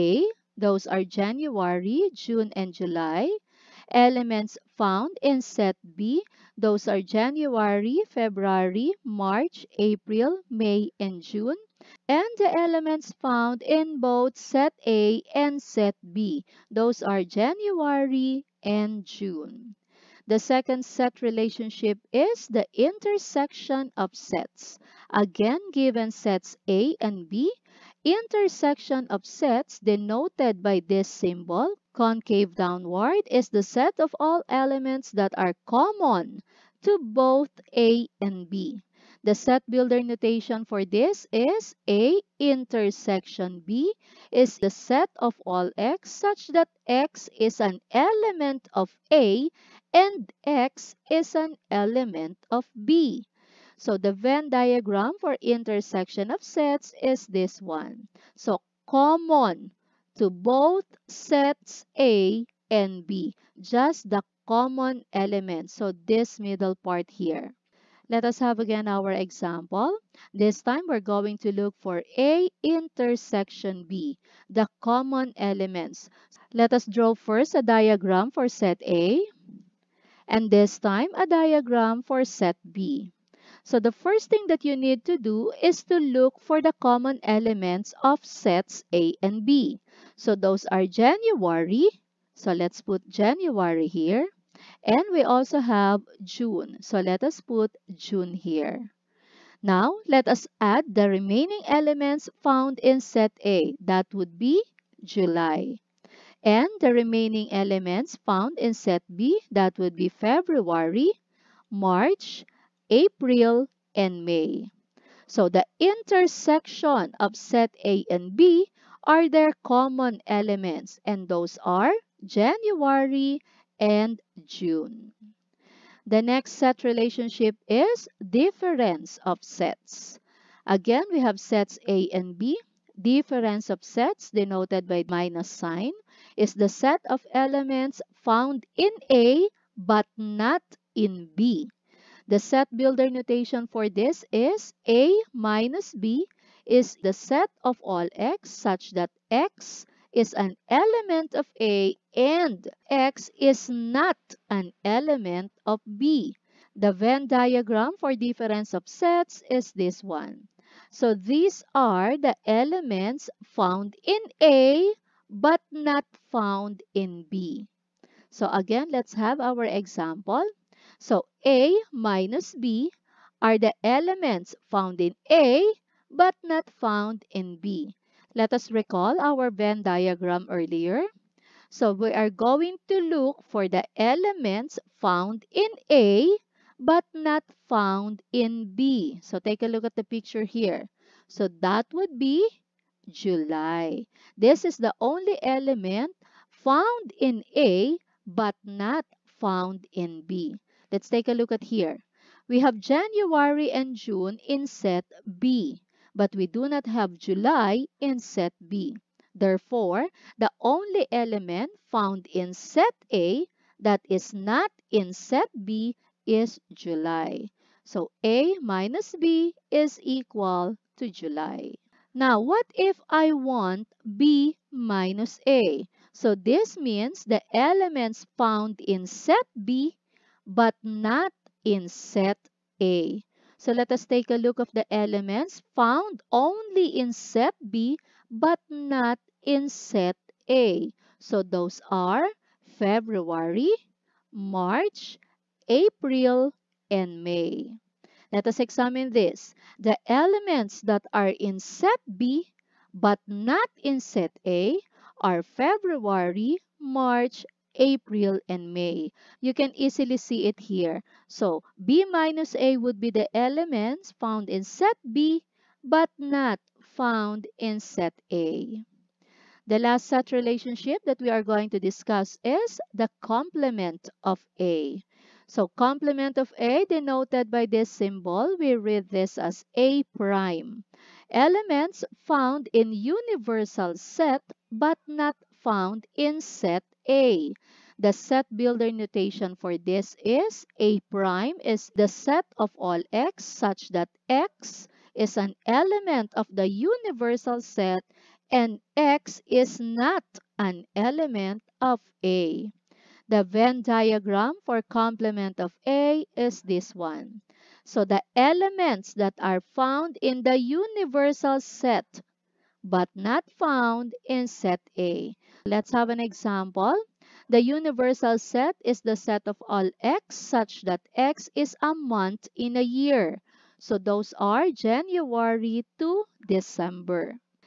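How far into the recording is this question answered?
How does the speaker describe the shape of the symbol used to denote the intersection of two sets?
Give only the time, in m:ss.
0:31.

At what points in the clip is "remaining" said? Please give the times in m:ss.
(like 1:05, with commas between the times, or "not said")
1:41, 1:46.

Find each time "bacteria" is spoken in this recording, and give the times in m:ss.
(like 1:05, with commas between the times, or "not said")
not said.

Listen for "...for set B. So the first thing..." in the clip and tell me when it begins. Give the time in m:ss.
1:22.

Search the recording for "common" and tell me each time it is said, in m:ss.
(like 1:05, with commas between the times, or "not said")
0:35, 0:58, 1:04, 1:14, 1:26, 1:59.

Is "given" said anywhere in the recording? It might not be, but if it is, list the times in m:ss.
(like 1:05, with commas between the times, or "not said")
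0:25.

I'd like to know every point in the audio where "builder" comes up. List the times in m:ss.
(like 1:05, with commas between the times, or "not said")
0:39, 2:22, 4:48.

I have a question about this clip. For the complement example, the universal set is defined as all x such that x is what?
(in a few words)
A month in a year.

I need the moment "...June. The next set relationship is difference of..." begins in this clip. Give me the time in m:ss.
2:04.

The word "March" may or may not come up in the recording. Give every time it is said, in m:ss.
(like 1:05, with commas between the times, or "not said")
0:09, 1:51, 4:04, 4:16.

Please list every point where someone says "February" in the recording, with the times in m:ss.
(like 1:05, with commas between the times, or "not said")
0:08, 1:50, 4:02, 4:15.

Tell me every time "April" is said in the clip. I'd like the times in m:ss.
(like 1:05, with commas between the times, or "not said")
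0:09, 1:52, 4:05, 4:17.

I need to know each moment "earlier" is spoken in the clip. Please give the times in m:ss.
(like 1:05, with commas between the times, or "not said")
3:00.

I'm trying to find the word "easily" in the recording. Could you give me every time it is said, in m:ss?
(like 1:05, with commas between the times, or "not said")
4:19.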